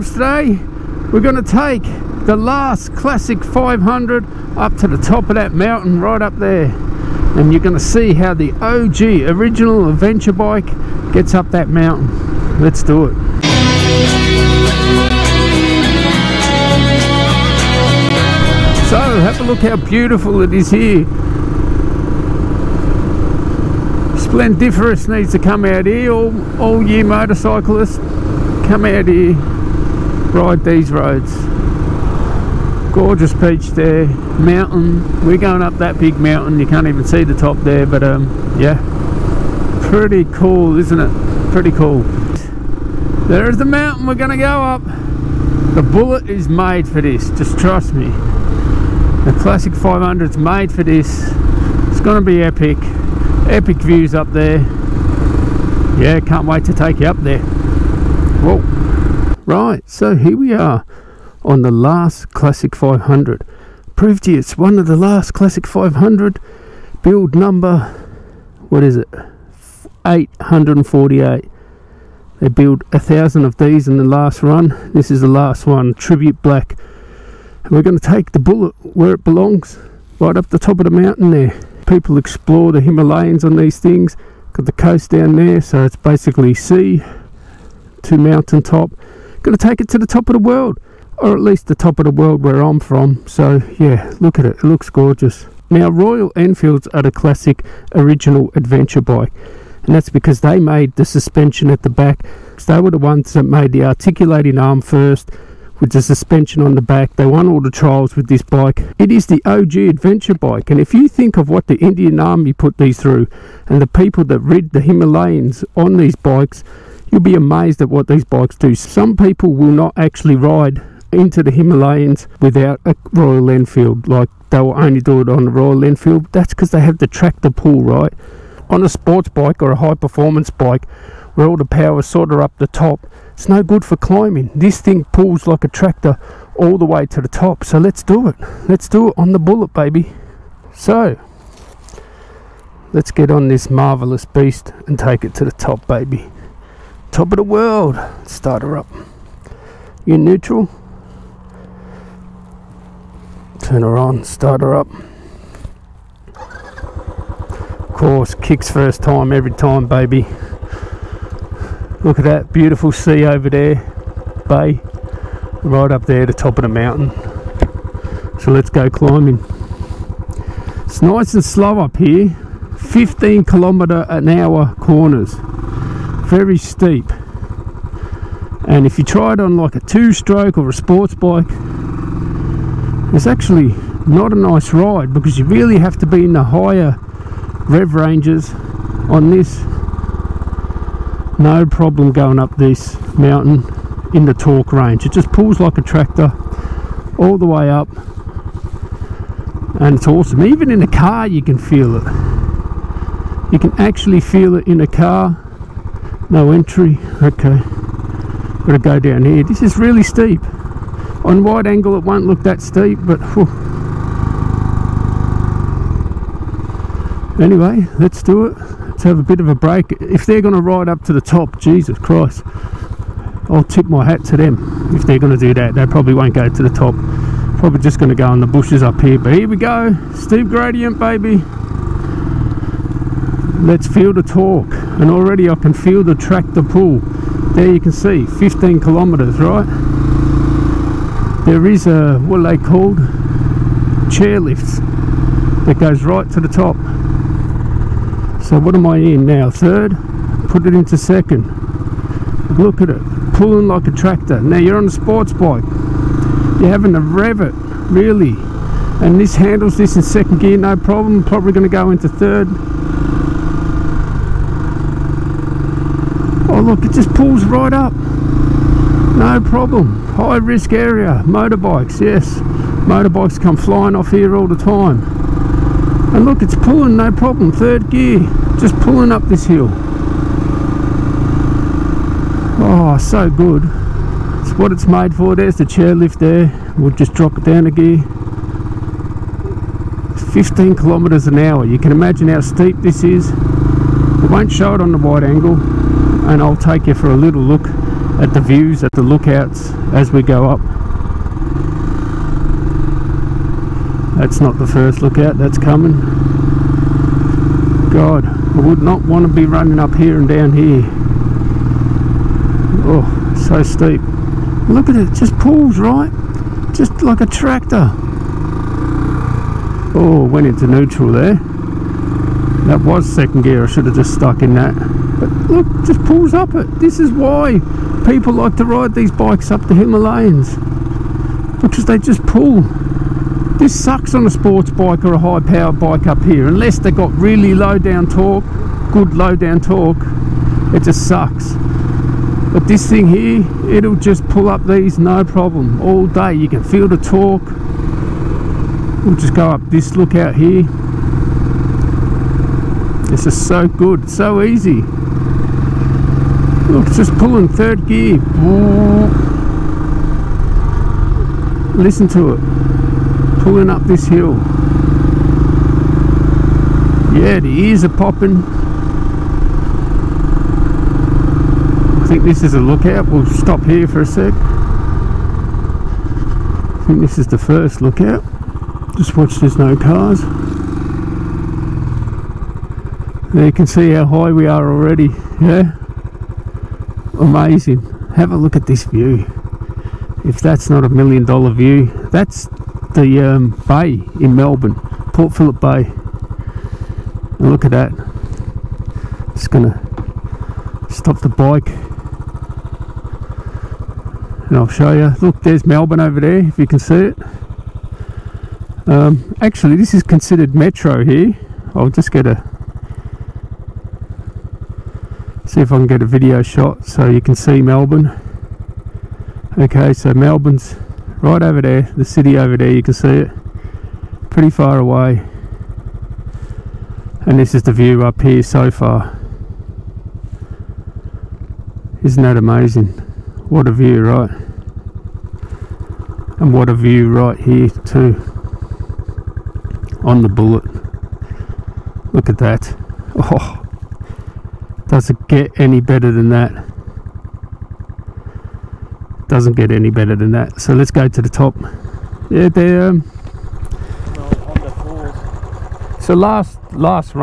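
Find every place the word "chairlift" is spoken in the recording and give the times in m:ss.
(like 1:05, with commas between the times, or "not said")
4:04, 4:45.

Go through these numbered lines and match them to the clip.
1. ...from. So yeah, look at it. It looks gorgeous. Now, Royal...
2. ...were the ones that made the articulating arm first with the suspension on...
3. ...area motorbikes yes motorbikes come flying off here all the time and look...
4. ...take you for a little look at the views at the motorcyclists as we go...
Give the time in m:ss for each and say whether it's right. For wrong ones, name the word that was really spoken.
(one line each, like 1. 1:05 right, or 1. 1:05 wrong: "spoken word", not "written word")
1. 1:32 right
2. 1:42 right
3. 4:30 right
4. 4:56 wrong: "lookouts", not "motorcyclists".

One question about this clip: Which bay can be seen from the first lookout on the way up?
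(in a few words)
Port Phillip Bay.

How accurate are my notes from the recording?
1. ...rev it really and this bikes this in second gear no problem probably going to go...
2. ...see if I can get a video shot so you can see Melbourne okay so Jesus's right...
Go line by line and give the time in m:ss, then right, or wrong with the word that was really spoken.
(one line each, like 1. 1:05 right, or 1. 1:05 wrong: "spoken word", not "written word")
1. 4:17 wrong: "handles", not "bikes"
2. 6:55 wrong: "Melbourne", not "Jesus".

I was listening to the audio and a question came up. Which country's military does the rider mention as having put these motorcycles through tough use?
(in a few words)
Indian Army.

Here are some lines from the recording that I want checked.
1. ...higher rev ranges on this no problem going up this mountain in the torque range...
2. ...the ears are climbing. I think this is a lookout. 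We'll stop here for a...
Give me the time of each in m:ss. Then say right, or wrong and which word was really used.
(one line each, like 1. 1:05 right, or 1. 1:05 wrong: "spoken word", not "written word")
1. 3:06 right
2. 6:07 wrong: "popping", not "climbing".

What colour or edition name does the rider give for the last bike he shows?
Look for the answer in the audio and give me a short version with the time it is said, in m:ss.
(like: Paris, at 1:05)
Tribute Black, at 1:15.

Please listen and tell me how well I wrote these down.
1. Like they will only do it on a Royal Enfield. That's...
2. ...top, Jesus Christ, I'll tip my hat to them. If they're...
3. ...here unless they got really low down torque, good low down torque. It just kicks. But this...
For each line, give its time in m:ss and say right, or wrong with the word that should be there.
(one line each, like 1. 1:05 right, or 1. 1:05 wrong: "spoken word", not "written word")
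1. 2:04 right
2. 3:41 right
3. 5:36 wrong: "sucks", not "kicks".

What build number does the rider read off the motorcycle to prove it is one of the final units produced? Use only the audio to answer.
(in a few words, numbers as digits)
848.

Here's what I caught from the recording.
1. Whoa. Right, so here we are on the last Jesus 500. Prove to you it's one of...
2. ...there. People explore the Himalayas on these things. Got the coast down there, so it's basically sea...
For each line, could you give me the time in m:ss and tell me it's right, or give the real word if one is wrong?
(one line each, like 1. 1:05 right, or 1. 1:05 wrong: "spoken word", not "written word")
1. 0:58 wrong: "Classic", not "Jesus"
2. 1:21 right.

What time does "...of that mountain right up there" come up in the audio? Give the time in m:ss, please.
0:05.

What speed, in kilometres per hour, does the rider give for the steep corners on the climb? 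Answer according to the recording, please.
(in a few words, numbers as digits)
15.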